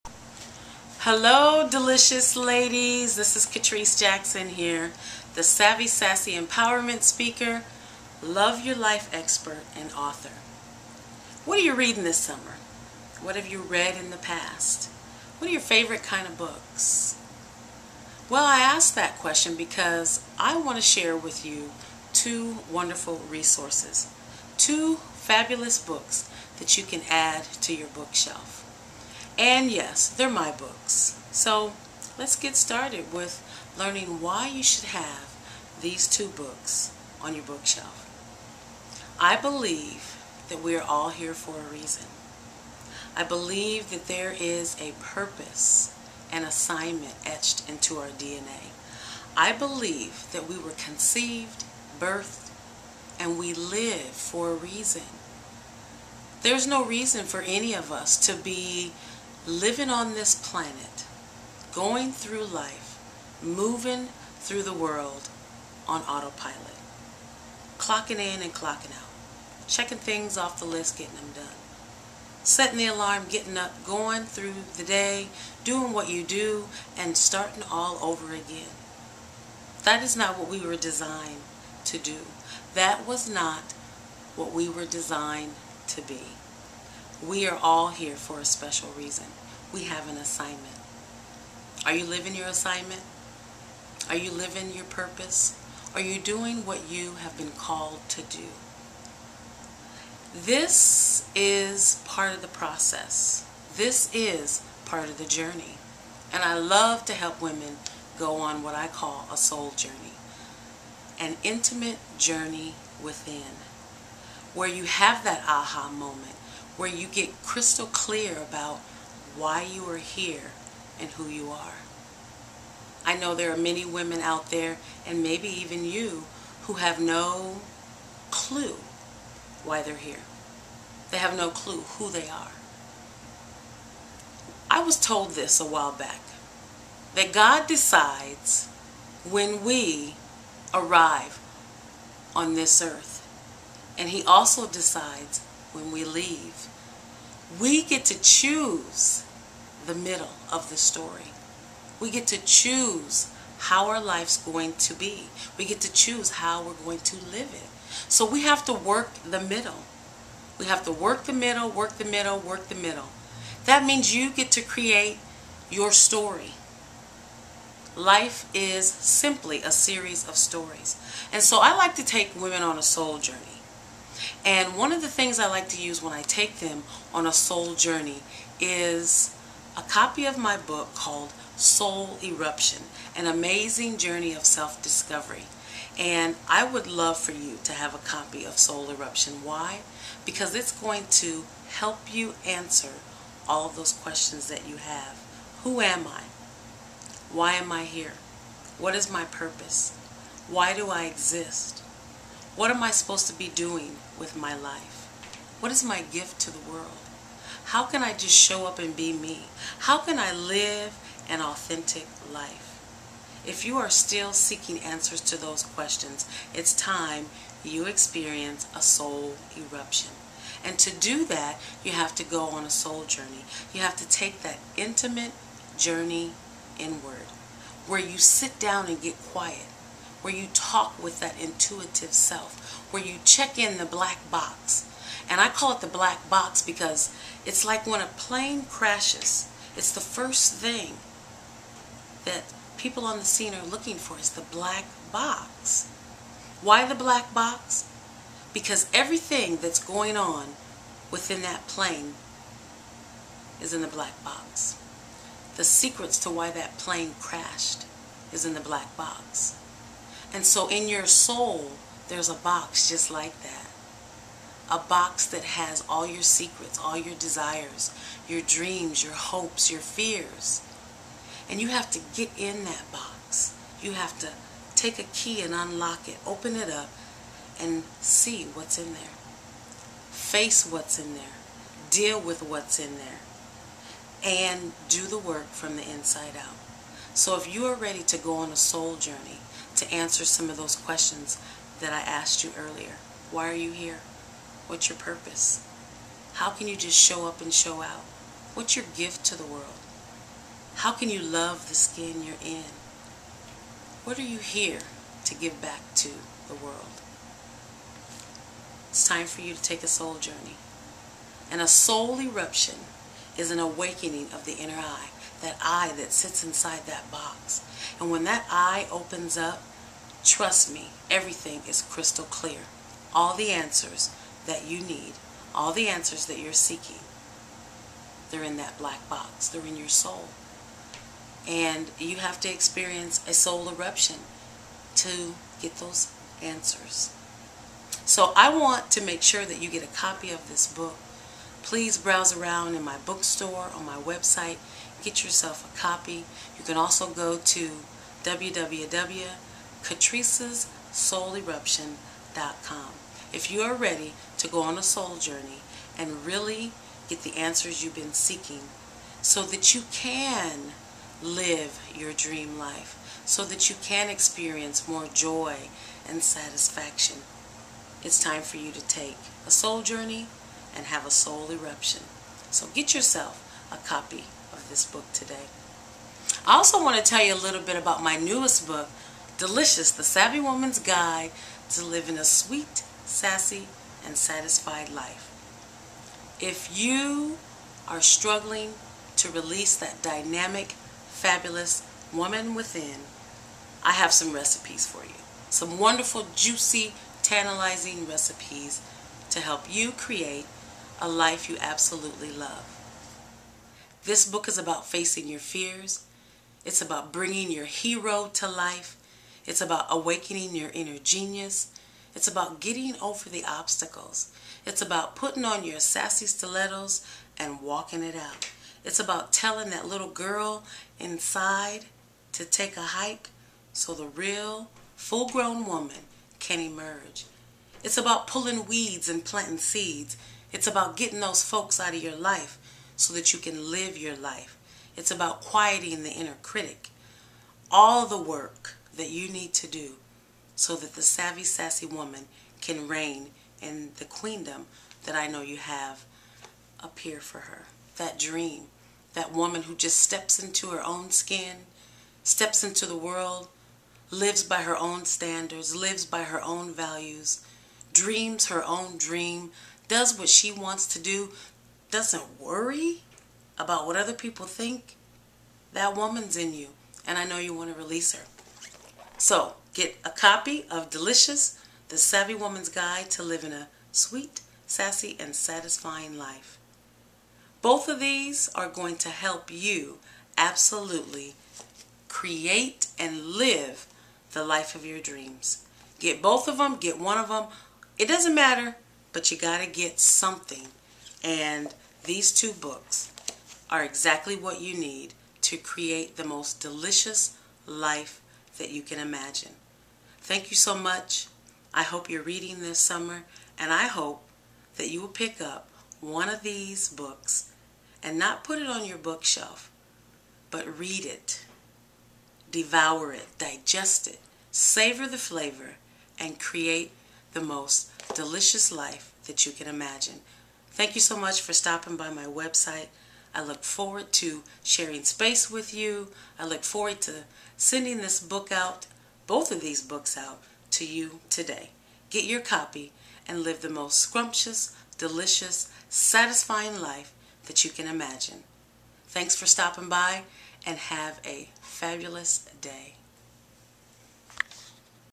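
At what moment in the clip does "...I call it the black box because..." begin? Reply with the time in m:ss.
3:55.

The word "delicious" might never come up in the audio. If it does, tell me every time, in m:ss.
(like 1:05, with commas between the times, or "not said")
0:01, 6:19, 7:50, 8:16, 8:38, 8:54.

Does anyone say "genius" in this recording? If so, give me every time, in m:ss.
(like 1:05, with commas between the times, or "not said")
6:50.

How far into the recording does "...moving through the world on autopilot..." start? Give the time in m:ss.
1:03.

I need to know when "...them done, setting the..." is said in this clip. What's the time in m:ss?
1:11.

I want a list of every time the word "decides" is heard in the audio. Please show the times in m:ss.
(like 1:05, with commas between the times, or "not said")
2:17, 2:24.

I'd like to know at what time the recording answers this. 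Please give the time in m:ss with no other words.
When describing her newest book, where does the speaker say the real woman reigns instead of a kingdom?
7:24.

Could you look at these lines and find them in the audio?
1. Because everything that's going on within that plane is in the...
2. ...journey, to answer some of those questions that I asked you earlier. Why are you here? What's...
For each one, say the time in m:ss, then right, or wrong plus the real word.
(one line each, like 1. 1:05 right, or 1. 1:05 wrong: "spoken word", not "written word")
1. 4:08 right
2. 4:48 right.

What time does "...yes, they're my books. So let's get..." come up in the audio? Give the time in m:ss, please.
0:29.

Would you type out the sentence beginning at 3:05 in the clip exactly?
And I would love for you to have a copy of Soul Eruption.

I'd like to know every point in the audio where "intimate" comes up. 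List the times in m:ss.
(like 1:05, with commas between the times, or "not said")
1:51, 3:44.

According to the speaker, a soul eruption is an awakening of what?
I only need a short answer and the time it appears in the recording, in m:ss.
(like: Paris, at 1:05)
The inner eye, at 5:14.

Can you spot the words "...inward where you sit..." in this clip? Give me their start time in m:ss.
3:46.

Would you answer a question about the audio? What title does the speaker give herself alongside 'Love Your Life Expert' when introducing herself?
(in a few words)
Savvy Sassy Empowerment Speaker.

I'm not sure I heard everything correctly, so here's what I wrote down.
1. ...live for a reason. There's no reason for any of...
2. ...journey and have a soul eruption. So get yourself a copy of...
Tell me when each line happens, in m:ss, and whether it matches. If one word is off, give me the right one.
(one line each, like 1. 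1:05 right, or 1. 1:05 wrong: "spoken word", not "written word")
1. 0:53 right
2. 6:09 right.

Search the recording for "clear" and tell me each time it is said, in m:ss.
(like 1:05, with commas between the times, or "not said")
1:57, 5:22.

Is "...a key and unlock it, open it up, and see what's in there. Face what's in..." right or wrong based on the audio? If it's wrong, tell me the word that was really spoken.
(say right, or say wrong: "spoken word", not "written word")
right.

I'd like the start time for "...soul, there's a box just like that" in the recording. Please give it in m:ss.
4:21.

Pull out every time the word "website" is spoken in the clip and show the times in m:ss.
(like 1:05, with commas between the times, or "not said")
5:43, 8:42.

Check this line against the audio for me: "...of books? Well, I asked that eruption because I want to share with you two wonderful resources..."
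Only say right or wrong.
wrong.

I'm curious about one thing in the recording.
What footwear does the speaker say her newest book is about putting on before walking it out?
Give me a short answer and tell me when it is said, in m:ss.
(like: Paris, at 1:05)
Sassy stilettos, at 6:55.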